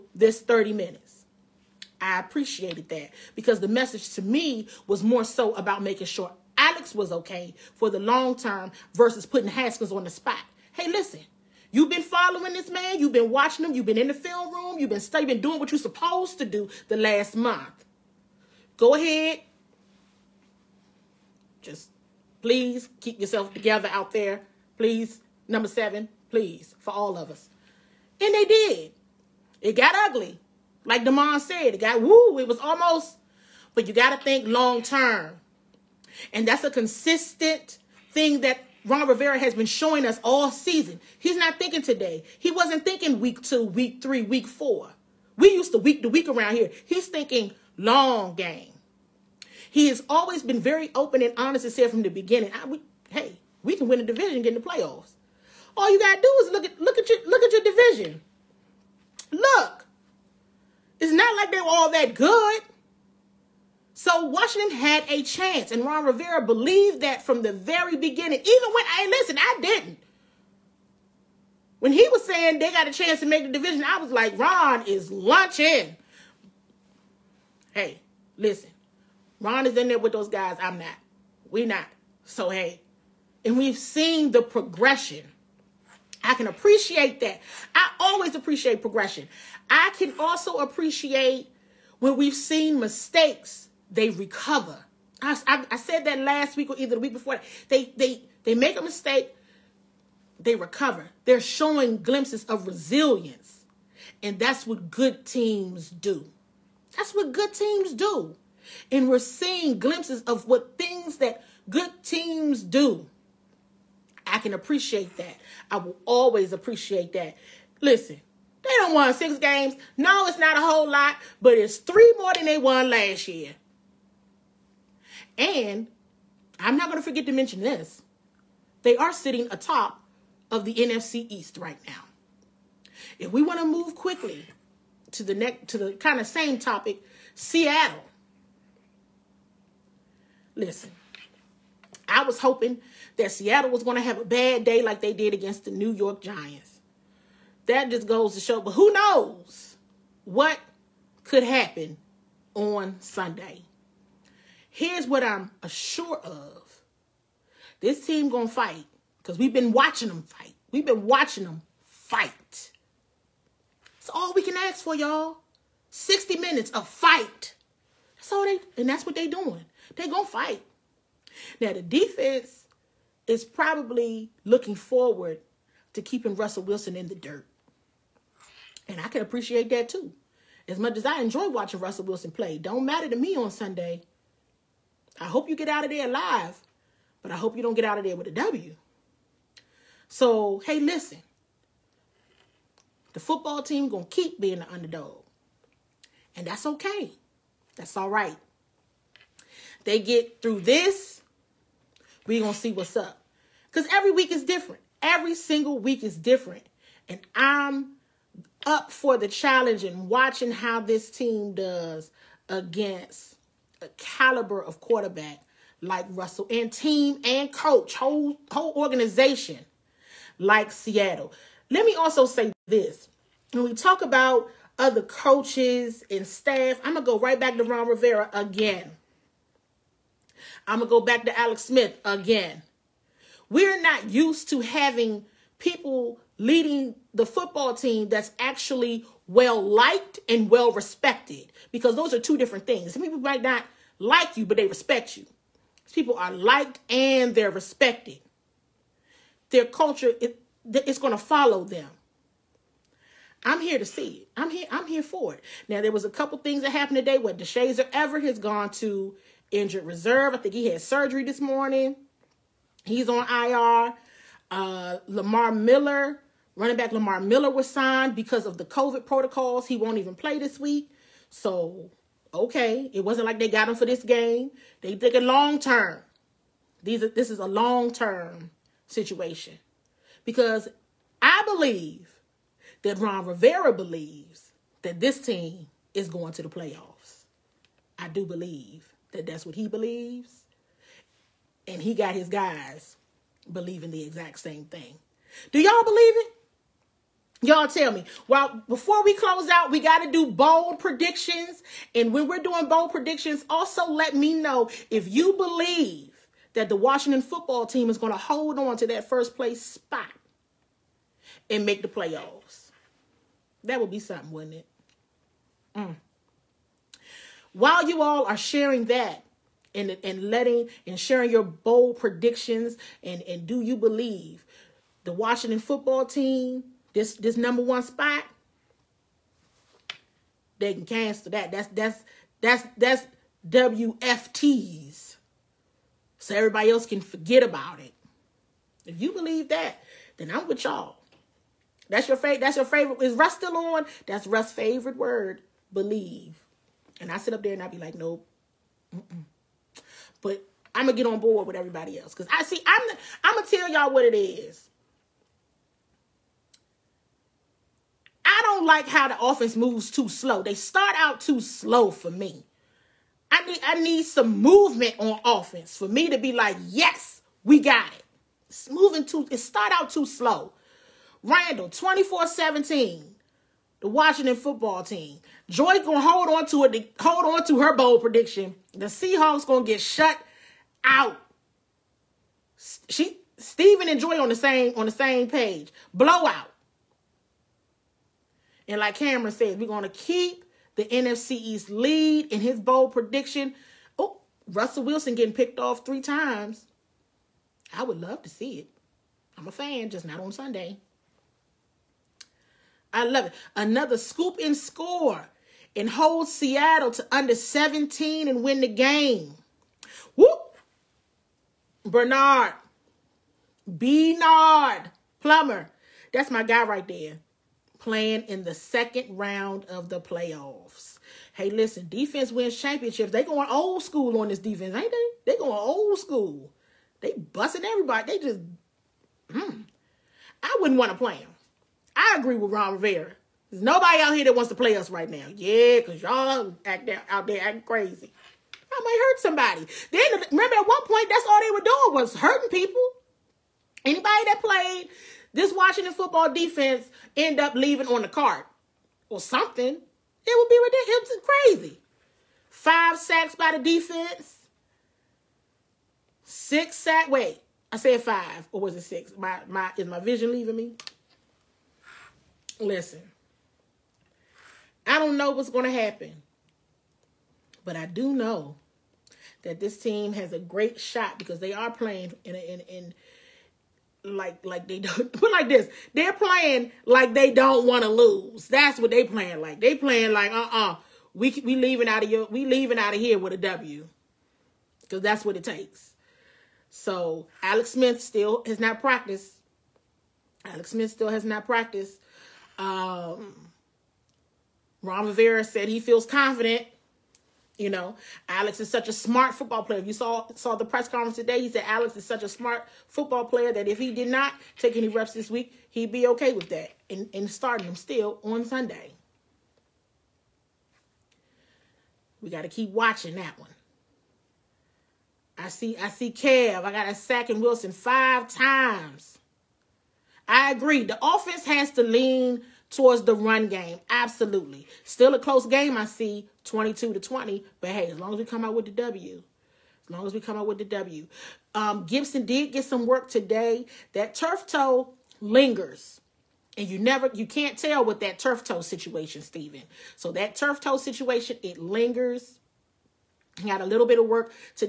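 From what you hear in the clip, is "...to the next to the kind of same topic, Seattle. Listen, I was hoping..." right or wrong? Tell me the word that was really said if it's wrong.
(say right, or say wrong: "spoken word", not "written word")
right.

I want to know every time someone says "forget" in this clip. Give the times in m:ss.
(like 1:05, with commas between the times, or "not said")
2:07, 5:37.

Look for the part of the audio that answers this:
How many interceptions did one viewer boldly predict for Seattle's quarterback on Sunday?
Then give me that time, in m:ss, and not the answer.
6:35.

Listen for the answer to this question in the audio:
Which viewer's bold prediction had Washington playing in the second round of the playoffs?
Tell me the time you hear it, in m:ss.
6:53.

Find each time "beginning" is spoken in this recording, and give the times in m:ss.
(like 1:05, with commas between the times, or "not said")
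0:52, 1:07.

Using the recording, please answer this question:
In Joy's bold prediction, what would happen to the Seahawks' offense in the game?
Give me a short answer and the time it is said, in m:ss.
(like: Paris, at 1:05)
Shut out, at 6:19.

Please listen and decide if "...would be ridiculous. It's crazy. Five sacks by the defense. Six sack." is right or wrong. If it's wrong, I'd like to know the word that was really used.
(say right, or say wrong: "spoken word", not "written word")
right.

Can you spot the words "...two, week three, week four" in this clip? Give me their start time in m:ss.
0:43.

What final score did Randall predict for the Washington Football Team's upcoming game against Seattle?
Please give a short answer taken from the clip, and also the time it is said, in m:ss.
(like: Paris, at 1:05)
24-17, at 6:11.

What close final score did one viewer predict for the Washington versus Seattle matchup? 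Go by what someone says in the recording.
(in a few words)
22-20.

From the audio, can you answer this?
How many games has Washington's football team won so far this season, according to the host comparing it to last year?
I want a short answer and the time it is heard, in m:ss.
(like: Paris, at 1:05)
6, at 1:59.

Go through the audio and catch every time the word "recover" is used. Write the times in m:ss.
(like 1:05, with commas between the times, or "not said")
1:34, 1:40.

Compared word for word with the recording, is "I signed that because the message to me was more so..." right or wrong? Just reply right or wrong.
wrong.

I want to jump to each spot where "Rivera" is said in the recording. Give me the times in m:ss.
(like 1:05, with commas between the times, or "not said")
0:39, 1:06, 3:47, 4:43, 7:12, 8:15.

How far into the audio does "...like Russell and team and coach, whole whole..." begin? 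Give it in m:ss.
3:35.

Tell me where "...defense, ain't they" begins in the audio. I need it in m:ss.
7:04.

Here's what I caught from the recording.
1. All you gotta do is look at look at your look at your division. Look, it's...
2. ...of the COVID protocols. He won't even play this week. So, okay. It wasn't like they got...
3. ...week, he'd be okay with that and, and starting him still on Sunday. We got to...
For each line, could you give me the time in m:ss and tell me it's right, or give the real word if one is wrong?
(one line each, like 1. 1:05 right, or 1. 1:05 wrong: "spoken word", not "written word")
1. 0:55 right
2. 4:28 right
3. 8:25 right.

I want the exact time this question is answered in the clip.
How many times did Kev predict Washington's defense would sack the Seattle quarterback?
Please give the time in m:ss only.
8:37.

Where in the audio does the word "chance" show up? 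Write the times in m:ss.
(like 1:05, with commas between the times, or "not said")
1:05, 1:12.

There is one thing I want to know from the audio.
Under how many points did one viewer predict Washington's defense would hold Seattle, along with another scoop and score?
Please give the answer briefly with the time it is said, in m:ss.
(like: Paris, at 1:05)
17, at 6:47.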